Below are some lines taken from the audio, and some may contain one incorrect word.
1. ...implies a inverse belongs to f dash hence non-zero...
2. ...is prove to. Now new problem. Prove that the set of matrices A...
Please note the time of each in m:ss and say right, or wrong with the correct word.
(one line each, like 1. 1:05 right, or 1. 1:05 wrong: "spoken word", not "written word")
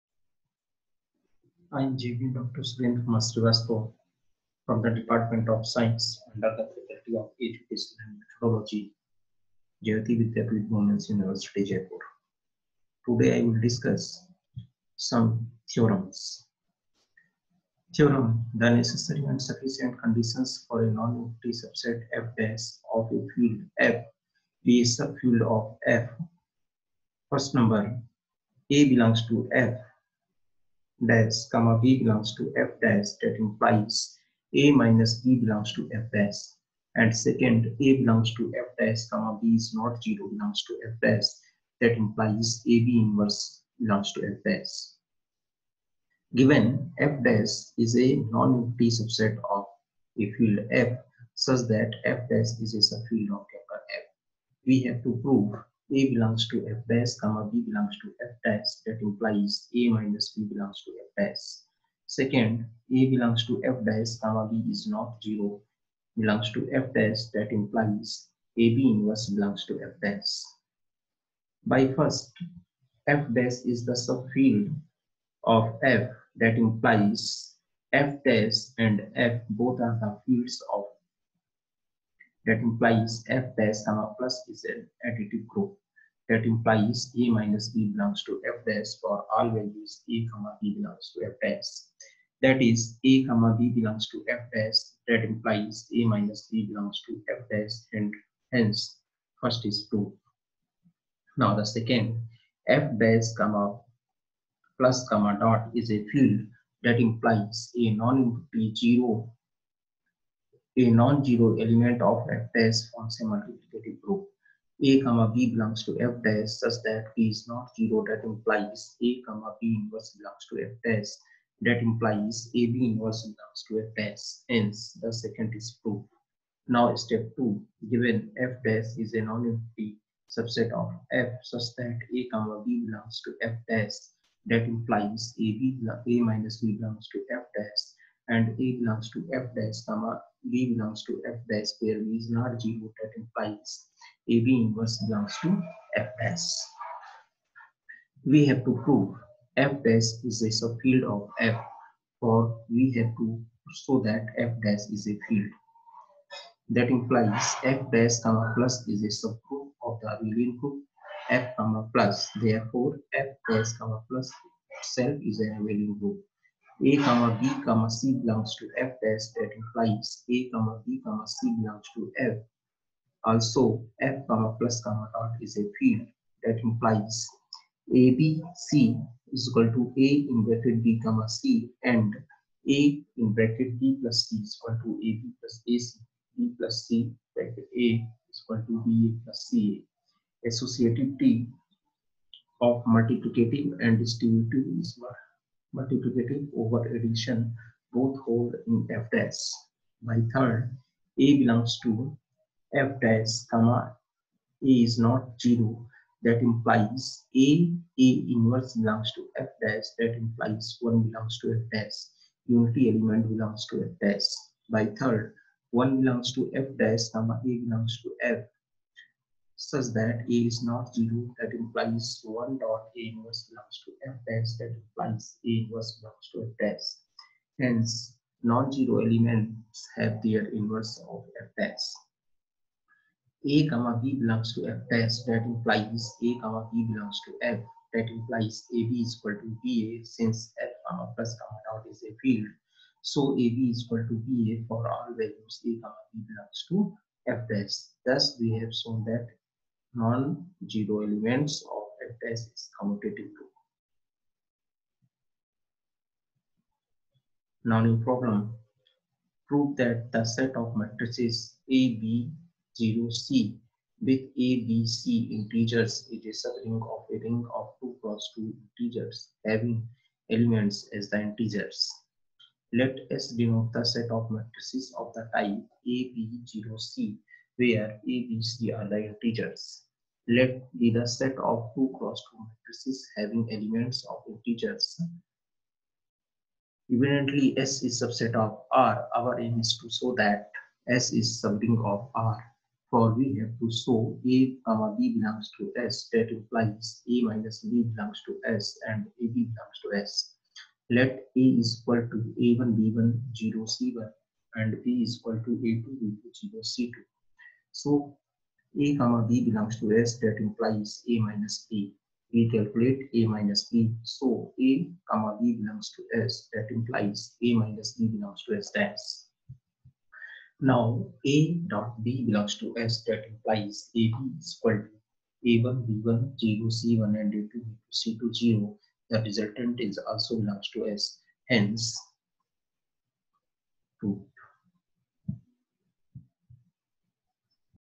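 1. 3:44 right
2. 4:12 wrong: "commutative", not "prove".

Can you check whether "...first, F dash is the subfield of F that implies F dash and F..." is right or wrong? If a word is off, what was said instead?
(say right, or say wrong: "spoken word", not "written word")
right.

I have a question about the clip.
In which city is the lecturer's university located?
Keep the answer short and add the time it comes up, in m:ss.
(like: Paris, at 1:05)
Jaipur, at 0:11.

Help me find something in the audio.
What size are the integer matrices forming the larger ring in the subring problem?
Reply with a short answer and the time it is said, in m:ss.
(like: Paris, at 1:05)
2 by 2, at 4:27.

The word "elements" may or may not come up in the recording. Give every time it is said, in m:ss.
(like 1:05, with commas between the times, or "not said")
1:51, 3:32, 3:49, 4:11, 4:30, 4:43.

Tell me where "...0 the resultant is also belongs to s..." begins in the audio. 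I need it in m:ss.
5:28.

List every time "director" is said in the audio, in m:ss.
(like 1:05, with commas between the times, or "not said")
not said.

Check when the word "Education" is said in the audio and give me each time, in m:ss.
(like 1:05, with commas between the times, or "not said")
0:07.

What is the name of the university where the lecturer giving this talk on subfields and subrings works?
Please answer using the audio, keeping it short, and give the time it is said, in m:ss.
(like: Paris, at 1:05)
Jayoti Vidya Women's University, at 0:09.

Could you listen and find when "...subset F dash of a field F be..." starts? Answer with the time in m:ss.
0:21.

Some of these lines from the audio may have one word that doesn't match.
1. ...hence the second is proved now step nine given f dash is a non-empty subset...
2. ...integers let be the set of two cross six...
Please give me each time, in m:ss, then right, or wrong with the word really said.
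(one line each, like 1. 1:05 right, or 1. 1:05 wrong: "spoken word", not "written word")
1. 2:04 wrong: "two", not "nine"
2. 4:39 wrong: "two", not "six".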